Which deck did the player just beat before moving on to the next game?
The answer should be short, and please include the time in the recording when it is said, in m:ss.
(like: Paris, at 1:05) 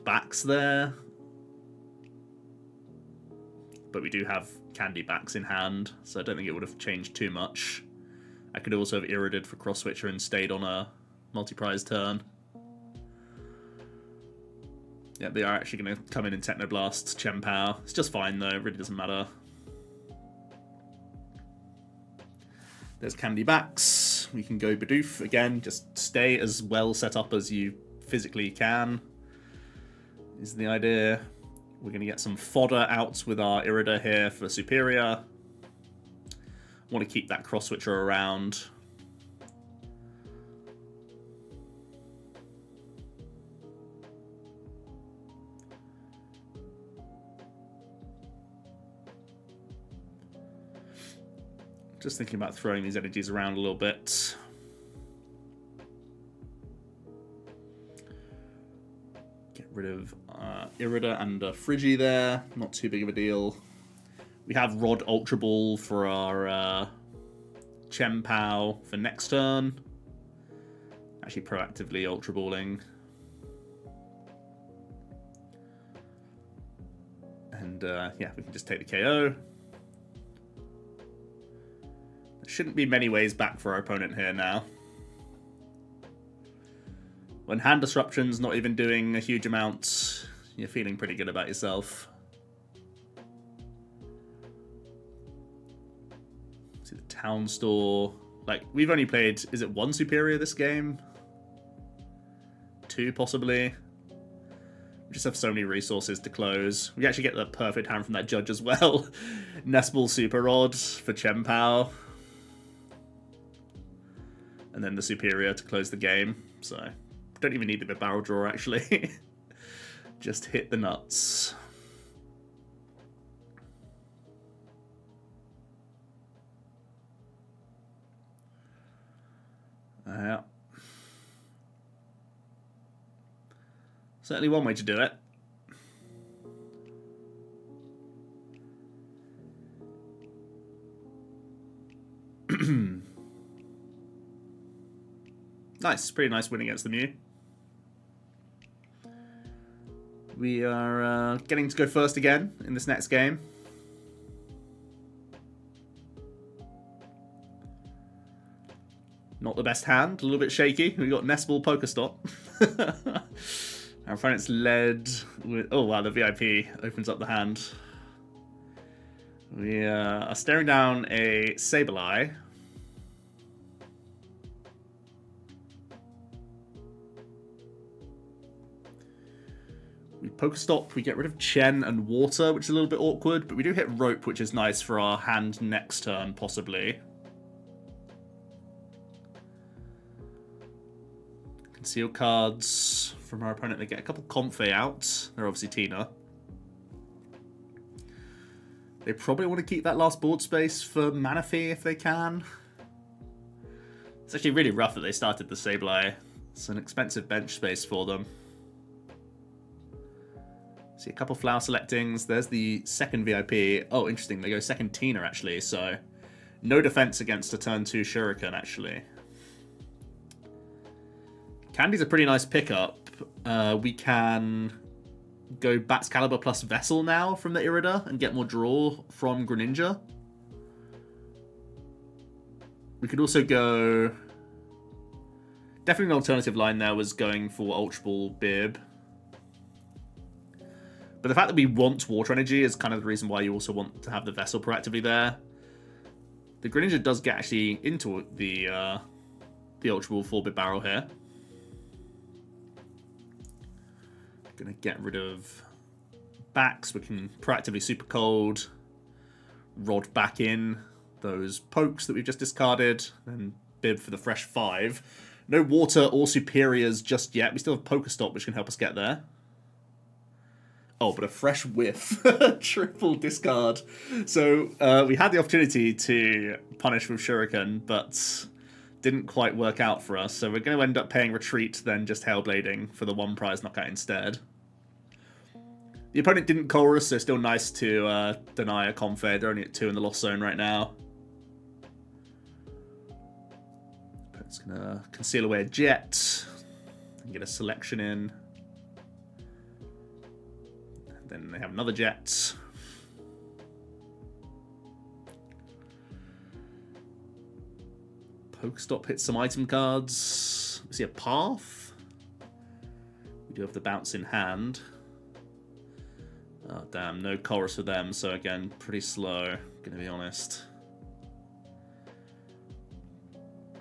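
Mew, at 2:26.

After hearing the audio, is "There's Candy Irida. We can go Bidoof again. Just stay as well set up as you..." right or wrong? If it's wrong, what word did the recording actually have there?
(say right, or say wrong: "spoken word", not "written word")
wrong: "Backs", not "Irida".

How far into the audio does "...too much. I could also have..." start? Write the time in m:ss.
0:07.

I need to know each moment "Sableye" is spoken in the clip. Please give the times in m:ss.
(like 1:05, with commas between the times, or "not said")
2:51, 3:25.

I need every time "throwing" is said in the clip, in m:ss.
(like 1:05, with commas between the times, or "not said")
0:52.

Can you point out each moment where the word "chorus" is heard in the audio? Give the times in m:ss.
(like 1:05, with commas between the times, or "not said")
4:46, 5:17.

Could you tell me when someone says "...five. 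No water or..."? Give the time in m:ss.
4:24.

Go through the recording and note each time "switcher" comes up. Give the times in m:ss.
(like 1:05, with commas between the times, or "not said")
0:09, 0:37.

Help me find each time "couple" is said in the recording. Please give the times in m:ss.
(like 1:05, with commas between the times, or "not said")
3:14, 3:31.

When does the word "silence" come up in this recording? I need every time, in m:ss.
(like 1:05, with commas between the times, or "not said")
not said.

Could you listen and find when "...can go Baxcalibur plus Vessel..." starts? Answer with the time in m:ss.
3:43.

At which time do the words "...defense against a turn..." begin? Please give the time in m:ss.
3:36.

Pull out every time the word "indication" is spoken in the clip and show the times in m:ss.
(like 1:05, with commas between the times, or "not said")
not said.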